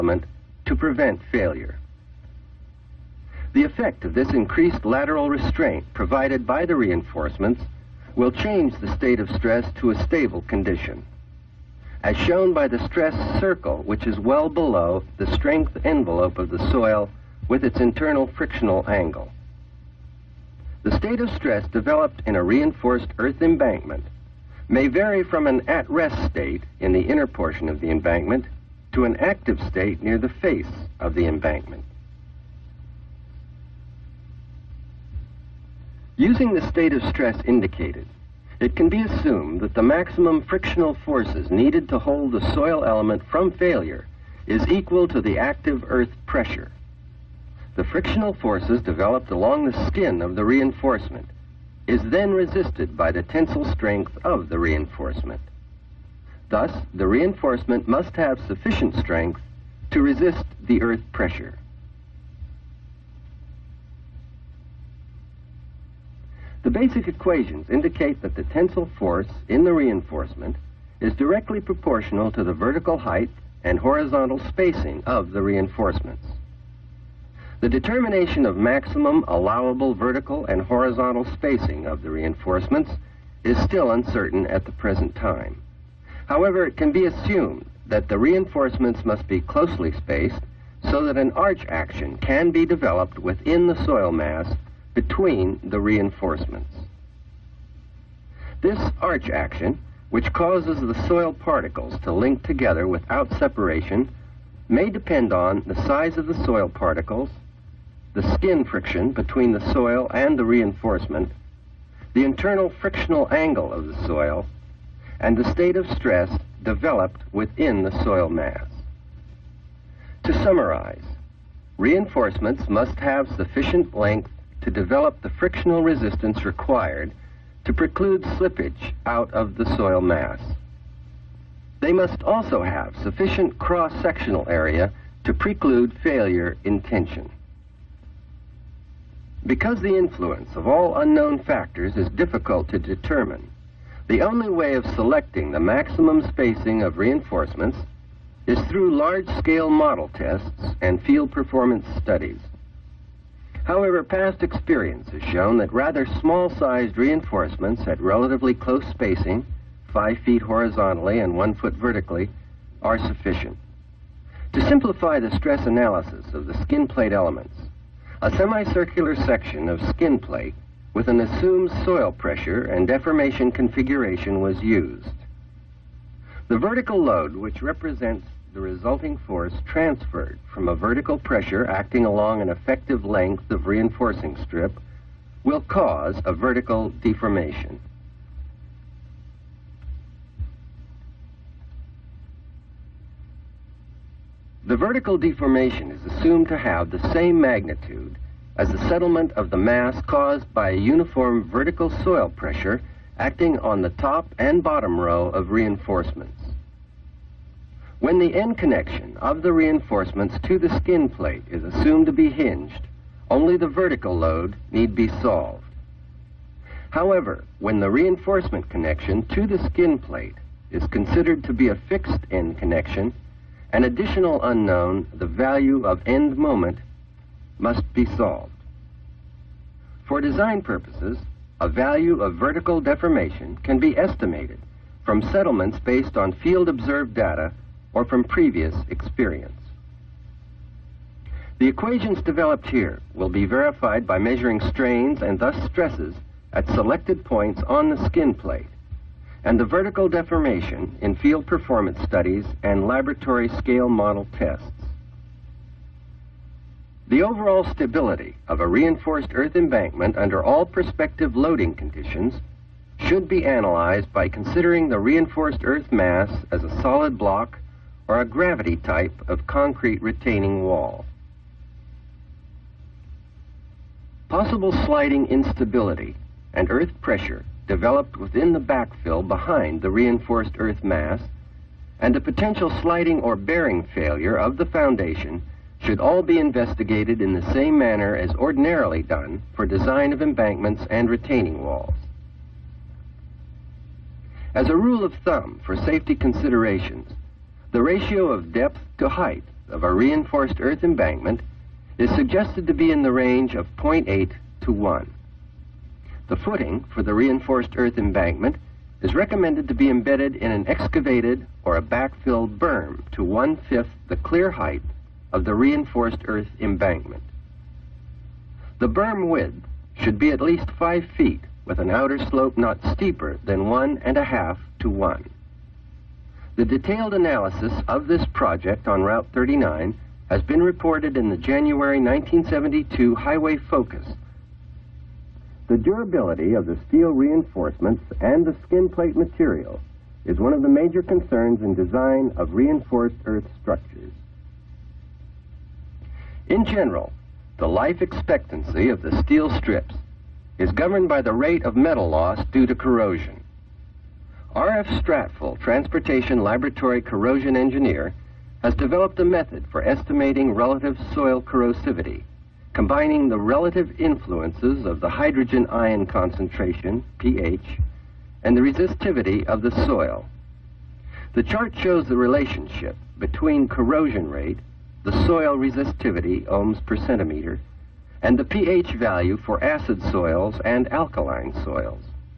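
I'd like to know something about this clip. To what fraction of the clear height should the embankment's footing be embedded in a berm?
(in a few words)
one-fifth.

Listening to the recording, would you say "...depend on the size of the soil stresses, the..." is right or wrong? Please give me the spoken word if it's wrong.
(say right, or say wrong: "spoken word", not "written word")
wrong: "particles", not "stresses".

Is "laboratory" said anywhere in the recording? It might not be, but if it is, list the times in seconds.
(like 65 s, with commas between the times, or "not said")
252 s, 356 s.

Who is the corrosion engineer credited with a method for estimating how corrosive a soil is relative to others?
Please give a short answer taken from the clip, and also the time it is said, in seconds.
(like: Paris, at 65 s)
R.F. Stratfull, at 354 s.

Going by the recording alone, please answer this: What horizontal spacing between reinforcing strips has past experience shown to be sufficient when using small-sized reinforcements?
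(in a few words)
5 feet.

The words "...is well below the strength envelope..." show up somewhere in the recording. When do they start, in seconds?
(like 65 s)
14 s.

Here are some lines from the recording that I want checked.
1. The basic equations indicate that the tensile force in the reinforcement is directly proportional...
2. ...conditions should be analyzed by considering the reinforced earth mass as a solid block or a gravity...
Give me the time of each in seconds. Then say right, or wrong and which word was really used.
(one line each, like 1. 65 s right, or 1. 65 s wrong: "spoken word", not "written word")
1. 66 s right
2. 261 s right.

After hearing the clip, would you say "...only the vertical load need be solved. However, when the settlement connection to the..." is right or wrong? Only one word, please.
wrong.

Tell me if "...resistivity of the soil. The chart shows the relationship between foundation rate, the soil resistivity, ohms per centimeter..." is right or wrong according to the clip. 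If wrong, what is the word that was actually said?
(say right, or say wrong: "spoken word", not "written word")
wrong: "corrosion", not "foundation".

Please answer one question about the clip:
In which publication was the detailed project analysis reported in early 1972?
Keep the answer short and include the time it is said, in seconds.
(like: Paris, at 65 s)
Highway Focus, at 333 s.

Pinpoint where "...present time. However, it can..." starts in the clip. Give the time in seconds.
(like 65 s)
84 s.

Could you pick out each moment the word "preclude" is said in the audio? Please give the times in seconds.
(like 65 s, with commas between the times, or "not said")
127 s, 135 s.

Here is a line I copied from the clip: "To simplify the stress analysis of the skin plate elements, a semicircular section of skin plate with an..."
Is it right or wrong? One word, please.
right.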